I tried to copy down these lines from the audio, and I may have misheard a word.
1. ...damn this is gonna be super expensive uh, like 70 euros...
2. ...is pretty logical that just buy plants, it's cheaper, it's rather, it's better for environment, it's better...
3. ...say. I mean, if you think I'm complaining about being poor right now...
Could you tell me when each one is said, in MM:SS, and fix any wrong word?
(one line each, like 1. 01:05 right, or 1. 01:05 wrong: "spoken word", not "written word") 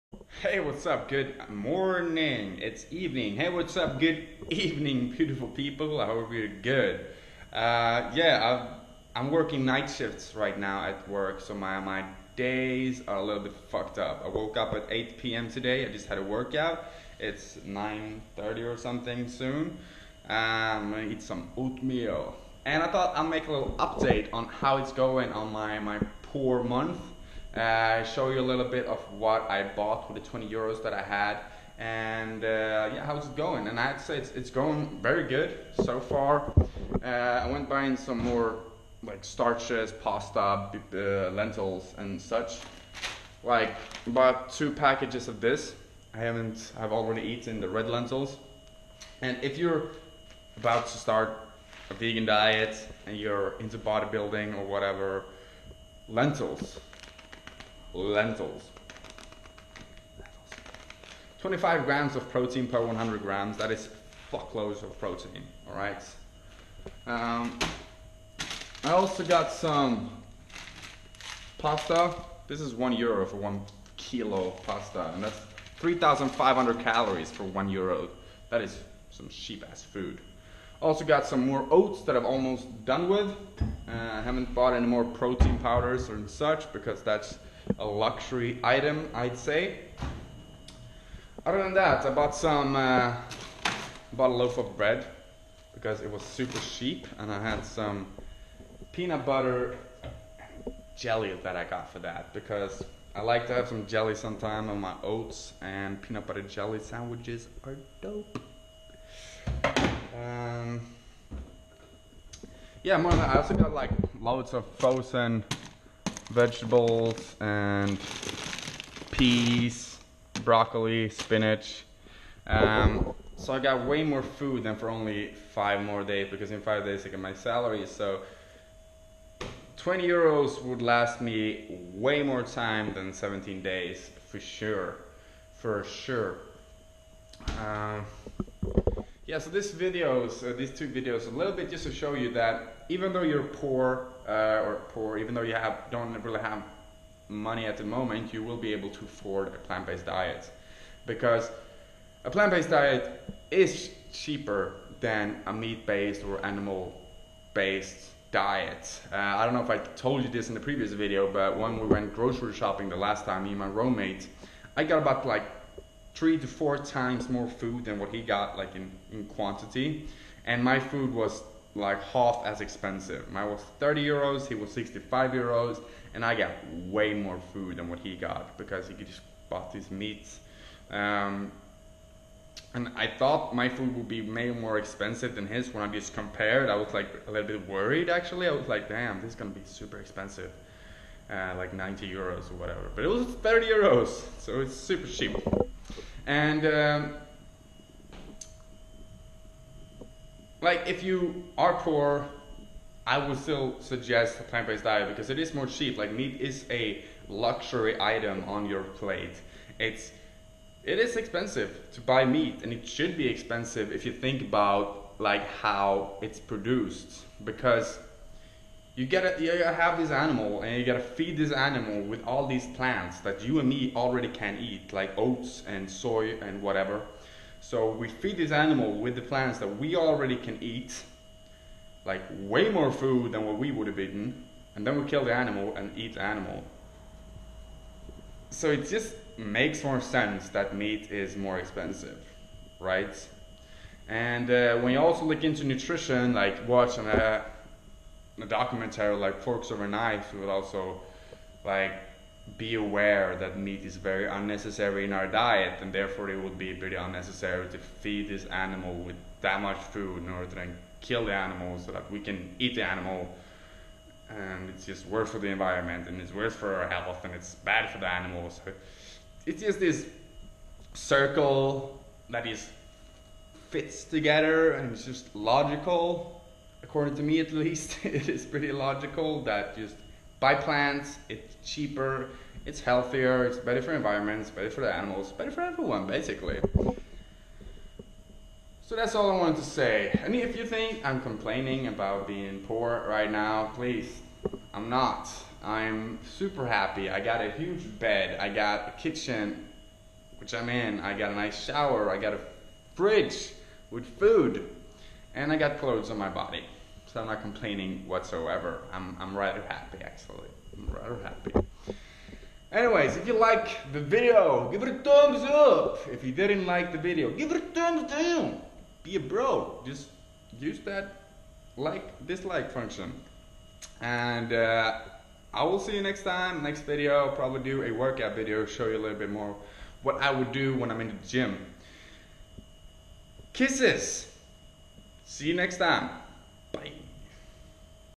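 1. 03:08 wrong: "90", not "70"
2. 04:38 wrong: "healthier", not "rather"
3. 04:49 right.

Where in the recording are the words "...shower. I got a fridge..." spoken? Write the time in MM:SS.
05:01.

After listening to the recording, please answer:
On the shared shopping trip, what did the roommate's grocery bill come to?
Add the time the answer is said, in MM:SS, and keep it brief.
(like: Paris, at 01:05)
65 euros, at 02:54.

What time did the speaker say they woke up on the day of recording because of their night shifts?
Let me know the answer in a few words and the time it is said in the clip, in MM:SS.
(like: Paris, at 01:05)
8 p.m., at 00:14.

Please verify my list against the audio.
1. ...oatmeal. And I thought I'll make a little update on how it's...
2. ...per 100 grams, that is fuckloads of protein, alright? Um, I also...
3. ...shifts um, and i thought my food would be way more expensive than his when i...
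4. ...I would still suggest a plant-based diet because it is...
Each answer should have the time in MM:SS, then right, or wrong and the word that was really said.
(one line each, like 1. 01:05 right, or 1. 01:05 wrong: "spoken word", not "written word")
1. 00:21 right
2. 01:02 right
3. 02:59 wrong: "meats", not "shifts"
4. 03:23 right.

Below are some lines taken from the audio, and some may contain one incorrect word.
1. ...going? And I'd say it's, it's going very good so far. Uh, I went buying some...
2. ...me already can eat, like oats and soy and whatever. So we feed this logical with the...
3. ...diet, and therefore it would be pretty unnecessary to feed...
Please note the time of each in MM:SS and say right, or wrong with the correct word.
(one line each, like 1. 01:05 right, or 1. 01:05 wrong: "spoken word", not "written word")
1. 00:33 right
2. 03:43 wrong: "animal", not "logical"
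3. 04:15 right.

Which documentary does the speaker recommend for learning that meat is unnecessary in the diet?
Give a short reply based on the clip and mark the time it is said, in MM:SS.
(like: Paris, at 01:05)
Forks Over Knives, at 04:09.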